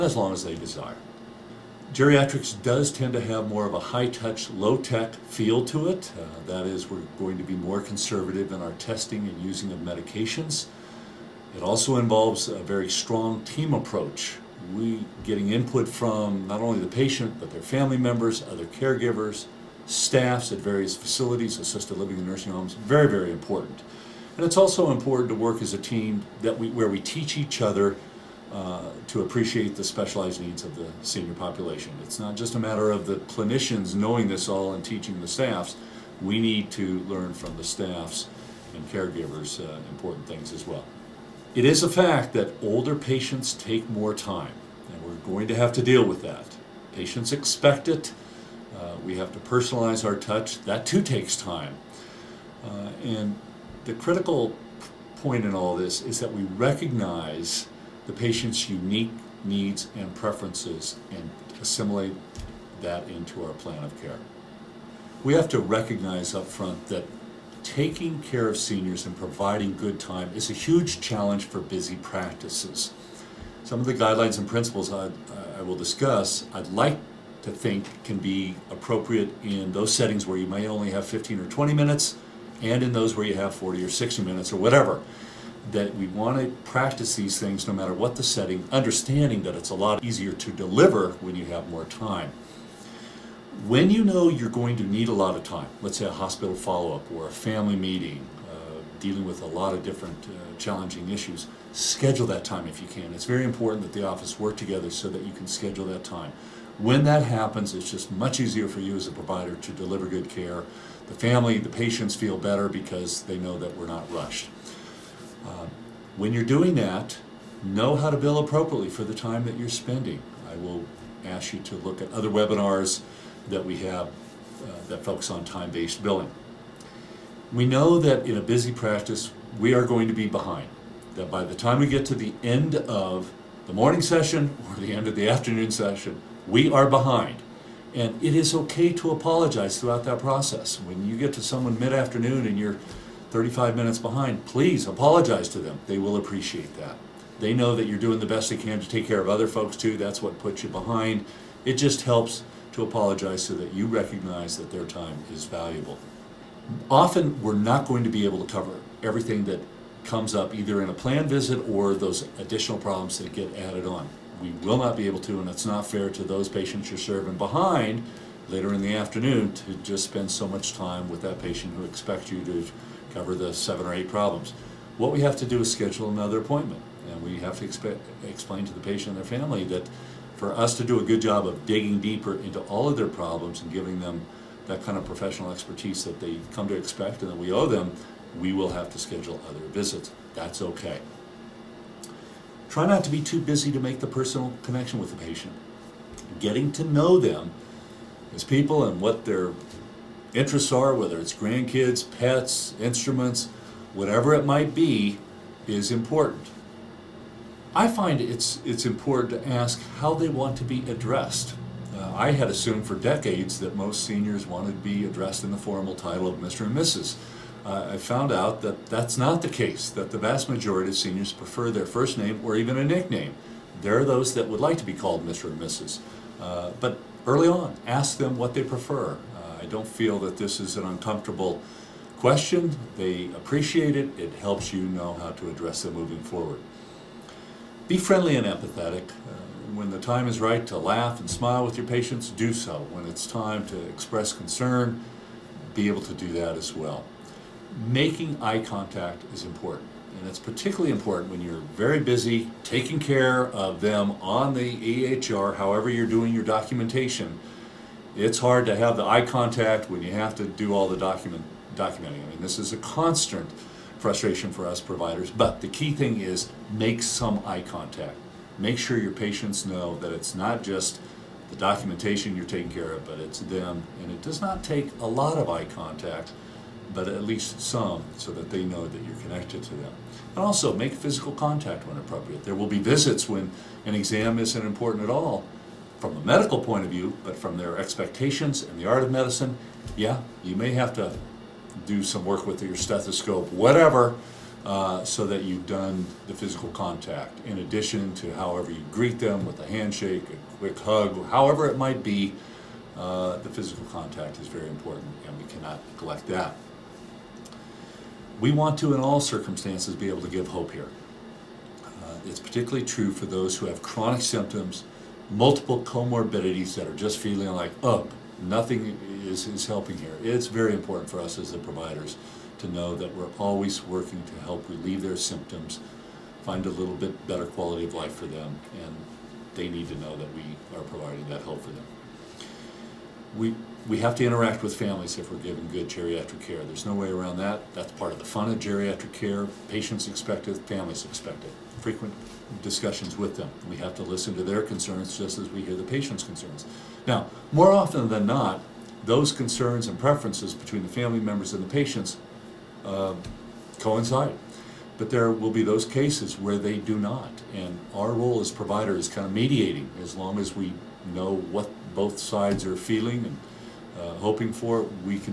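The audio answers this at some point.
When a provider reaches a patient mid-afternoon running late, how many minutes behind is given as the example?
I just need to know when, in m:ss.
2:23.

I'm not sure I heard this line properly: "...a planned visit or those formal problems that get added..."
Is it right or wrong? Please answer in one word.
wrong.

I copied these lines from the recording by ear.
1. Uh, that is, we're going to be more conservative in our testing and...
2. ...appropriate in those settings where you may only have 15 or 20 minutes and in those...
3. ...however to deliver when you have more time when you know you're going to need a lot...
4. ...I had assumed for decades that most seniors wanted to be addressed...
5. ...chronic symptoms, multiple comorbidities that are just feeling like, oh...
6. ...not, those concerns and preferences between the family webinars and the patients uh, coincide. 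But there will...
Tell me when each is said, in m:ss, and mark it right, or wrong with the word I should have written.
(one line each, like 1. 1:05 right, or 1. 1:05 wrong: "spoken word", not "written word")
1. 0:06 right
2. 1:18 right
3. 1:30 wrong: "easier", not "however"
4. 3:32 right
5. 5:13 right
6. 5:48 wrong: "members", not "webinars".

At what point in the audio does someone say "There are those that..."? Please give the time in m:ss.
3:43.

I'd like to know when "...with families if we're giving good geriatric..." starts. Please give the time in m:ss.
5:34.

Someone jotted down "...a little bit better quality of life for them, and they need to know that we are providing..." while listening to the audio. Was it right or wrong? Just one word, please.
right.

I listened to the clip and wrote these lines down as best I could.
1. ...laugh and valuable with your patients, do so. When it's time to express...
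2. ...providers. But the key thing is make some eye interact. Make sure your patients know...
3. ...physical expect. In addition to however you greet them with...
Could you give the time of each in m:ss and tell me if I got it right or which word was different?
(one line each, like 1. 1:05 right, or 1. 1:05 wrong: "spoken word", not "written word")
1. 4:00 wrong: "smile", not "valuable"
2. 4:24 wrong: "contact", not "interact"
3. 4:56 wrong: "contact", not "expect".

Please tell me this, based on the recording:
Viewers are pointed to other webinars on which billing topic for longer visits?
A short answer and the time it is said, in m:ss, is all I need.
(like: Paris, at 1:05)
time-based billing, at 2:05.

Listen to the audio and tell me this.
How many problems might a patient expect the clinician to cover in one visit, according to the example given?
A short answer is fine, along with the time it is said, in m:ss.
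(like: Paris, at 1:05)
seven or eight, at 2:53.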